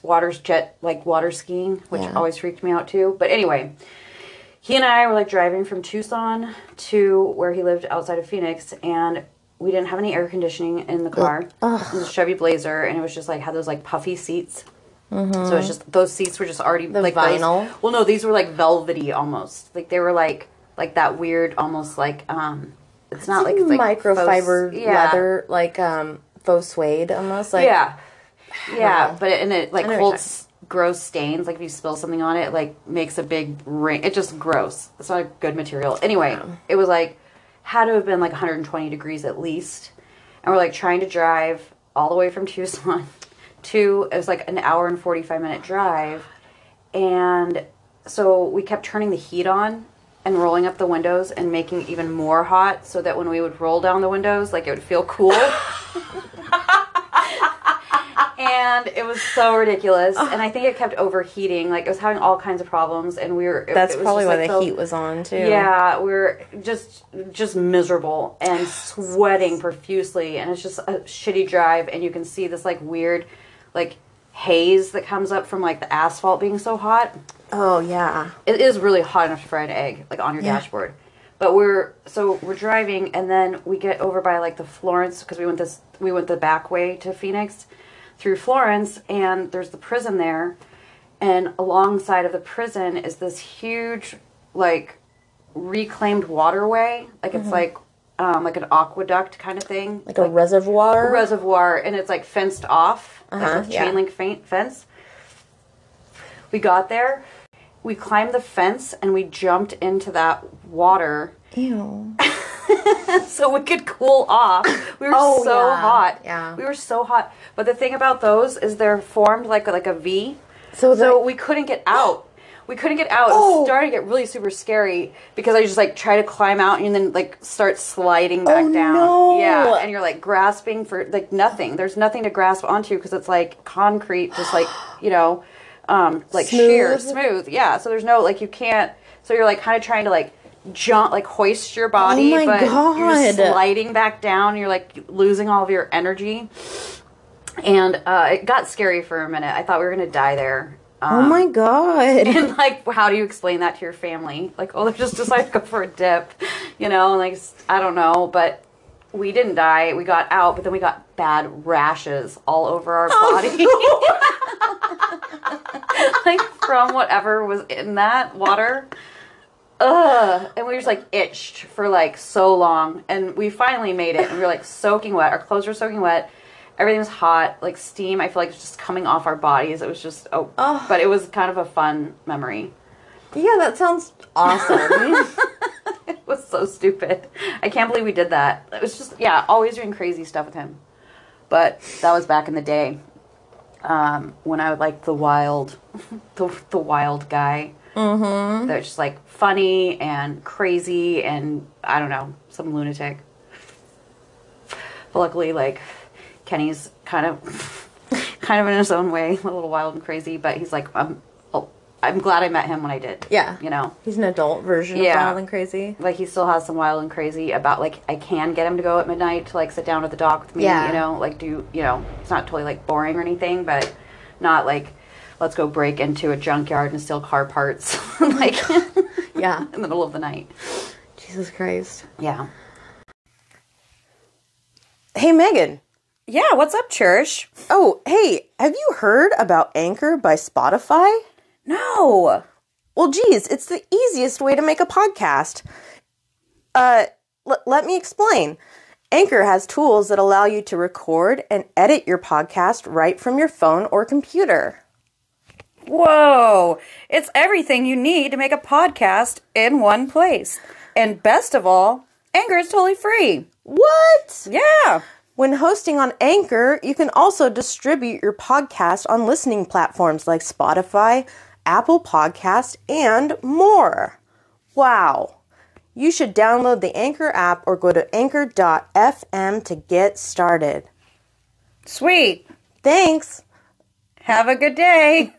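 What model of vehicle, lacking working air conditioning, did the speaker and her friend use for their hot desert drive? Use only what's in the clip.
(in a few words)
Chevy Blazer.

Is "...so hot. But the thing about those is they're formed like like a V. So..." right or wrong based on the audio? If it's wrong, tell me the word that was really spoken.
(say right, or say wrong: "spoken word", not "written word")
right.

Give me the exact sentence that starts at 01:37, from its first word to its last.
like um, like an aqueduct kind of thing, like, like a reservoir, a reservoir, and it's like fenced off, uh-huh, like yeah.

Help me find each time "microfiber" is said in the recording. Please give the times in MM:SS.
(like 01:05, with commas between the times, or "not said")
00:23.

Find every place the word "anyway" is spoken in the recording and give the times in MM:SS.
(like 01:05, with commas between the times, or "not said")
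00:03, 00:36.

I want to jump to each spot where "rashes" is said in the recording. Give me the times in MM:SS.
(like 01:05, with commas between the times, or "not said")
02:41.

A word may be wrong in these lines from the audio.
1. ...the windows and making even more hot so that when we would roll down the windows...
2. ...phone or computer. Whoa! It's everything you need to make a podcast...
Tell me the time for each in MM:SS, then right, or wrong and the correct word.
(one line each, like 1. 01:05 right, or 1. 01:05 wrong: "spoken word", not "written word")
1. 00:50 right
2. 04:13 right.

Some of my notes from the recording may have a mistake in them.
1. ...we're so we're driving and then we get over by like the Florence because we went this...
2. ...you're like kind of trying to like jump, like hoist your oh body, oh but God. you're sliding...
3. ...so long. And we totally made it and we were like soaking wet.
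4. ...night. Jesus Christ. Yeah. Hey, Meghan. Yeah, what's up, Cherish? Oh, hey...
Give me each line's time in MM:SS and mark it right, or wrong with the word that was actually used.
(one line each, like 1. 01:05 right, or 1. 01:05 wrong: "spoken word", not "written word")
1. 01:21 right
2. 02:19 right
3. 02:52 wrong: "finally", not "totally"
4. 03:50 right.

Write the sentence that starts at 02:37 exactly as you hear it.
Like, I don't know, but we didn't die.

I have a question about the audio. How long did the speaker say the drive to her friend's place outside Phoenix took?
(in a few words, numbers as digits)
1 hour and 45 minutes.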